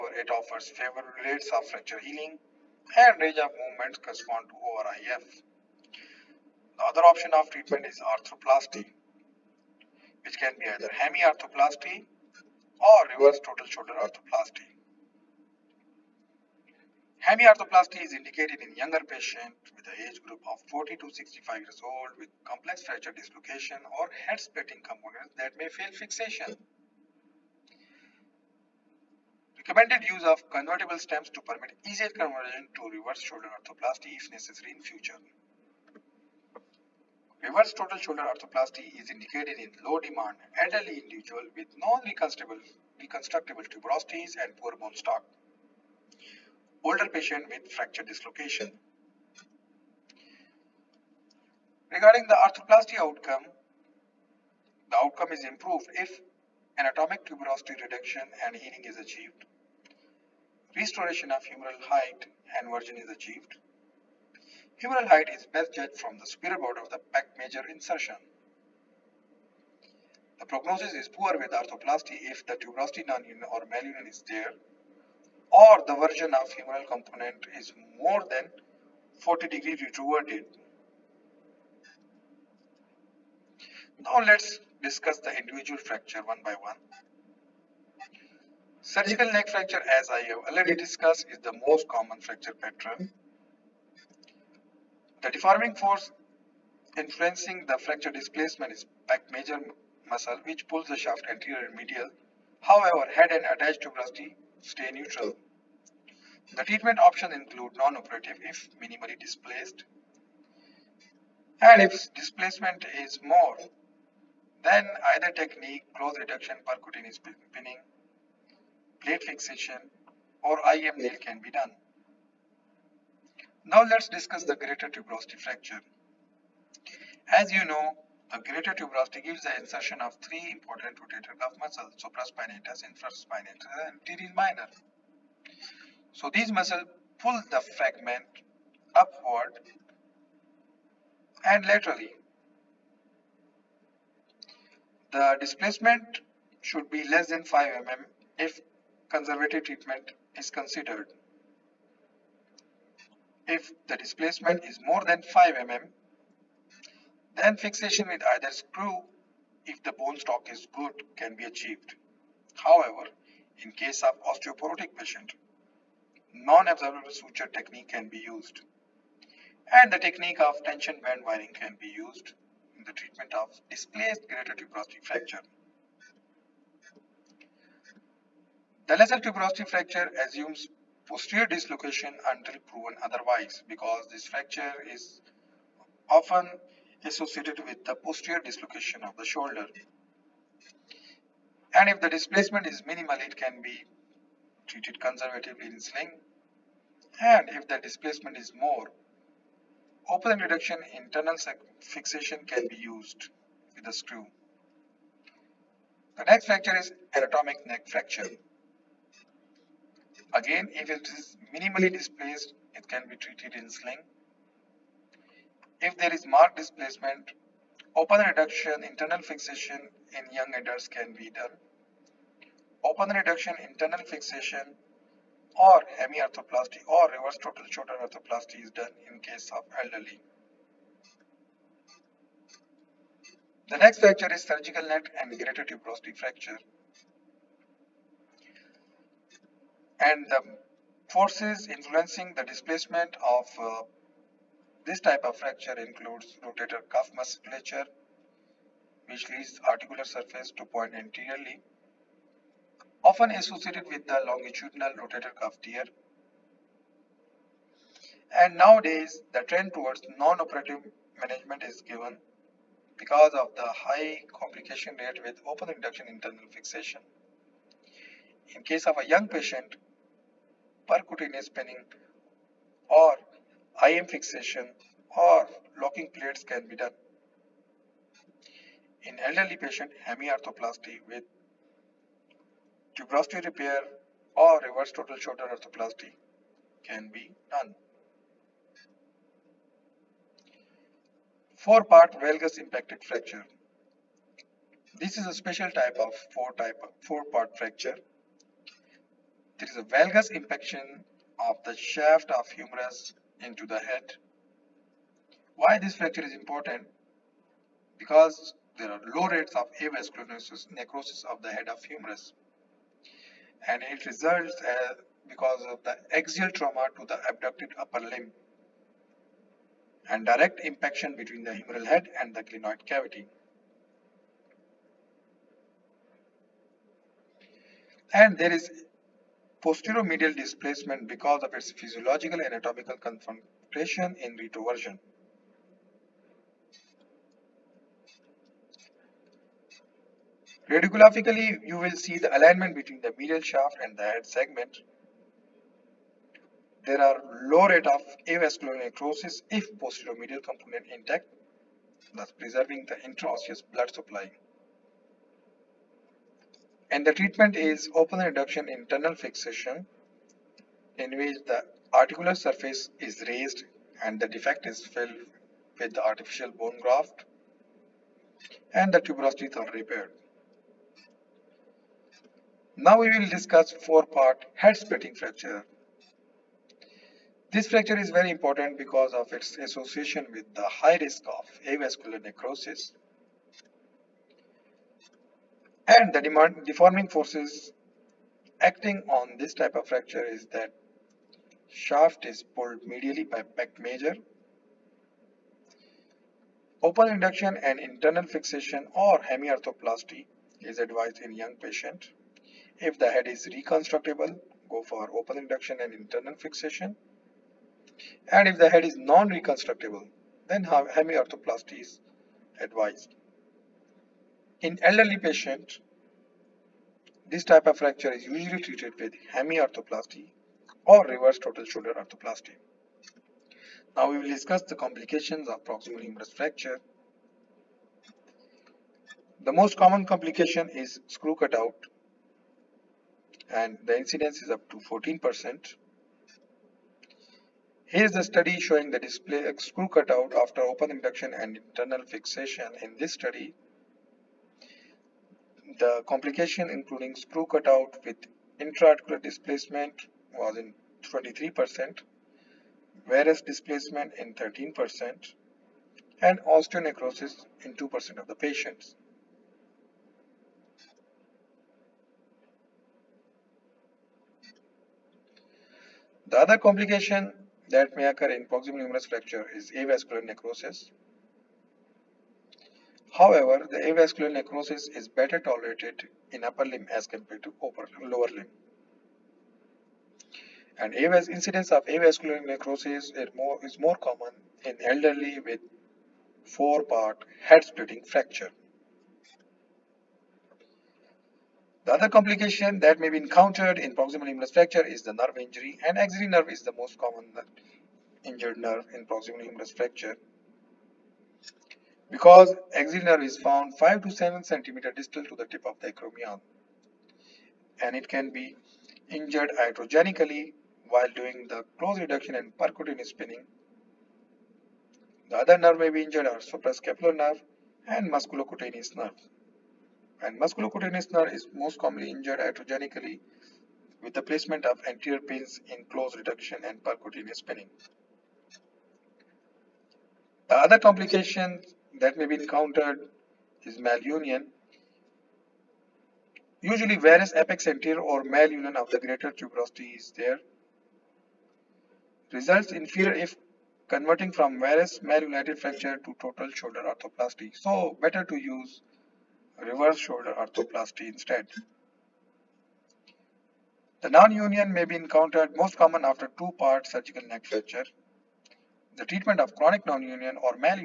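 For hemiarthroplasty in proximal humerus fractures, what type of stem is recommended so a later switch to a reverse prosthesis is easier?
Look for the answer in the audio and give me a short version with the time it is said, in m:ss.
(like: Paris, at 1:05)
convertible stems, at 0:30.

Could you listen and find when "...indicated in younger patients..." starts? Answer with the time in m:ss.
0:18.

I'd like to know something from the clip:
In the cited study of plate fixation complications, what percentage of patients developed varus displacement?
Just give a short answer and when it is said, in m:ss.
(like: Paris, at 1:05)
13%, at 7:34.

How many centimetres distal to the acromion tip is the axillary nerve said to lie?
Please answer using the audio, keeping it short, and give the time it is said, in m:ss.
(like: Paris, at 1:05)
5 to 7 cm, at 8:23.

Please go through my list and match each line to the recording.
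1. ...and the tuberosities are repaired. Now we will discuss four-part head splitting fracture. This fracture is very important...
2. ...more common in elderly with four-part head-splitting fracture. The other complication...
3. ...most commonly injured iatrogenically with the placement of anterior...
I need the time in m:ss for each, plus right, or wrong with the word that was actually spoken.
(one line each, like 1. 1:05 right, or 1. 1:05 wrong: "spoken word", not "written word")
1. 6:08 right
2. 8:03 right
3. 8:41 right.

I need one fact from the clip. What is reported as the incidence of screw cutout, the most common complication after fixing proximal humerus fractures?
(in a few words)
up to 14%.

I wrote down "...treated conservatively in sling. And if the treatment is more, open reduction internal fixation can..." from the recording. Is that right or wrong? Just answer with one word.
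wrong.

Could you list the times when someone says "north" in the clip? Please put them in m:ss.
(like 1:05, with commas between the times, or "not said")
not said.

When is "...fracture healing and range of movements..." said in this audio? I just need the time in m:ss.
0:01.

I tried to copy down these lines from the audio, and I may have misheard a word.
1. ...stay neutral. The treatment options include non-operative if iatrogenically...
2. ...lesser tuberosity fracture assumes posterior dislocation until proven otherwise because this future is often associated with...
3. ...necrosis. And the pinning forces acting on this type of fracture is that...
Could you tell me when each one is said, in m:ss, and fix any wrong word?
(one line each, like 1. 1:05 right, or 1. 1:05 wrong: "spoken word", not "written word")
1. 1:44 wrong: "minimally", not "iatrogenically"
2. 2:58 wrong: "fracture", not "future"
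3. 6:22 wrong: "deforming", not "pinning".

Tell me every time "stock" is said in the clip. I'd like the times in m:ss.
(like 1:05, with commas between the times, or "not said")
0:44, 2:40.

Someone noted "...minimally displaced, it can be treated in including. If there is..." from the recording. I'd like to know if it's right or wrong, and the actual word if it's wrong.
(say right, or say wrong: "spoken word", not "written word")
wrong: "sling", not "including".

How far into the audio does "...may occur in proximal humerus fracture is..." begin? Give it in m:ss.
7:47.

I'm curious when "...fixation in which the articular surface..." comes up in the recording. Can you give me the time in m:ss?
5:59.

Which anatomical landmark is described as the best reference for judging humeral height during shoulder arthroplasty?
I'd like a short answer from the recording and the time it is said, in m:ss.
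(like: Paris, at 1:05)
superior border of the pec major insertion, at 1:06.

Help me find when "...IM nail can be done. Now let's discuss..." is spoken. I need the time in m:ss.
2:00.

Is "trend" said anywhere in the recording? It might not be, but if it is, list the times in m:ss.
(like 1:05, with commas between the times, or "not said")
4:19.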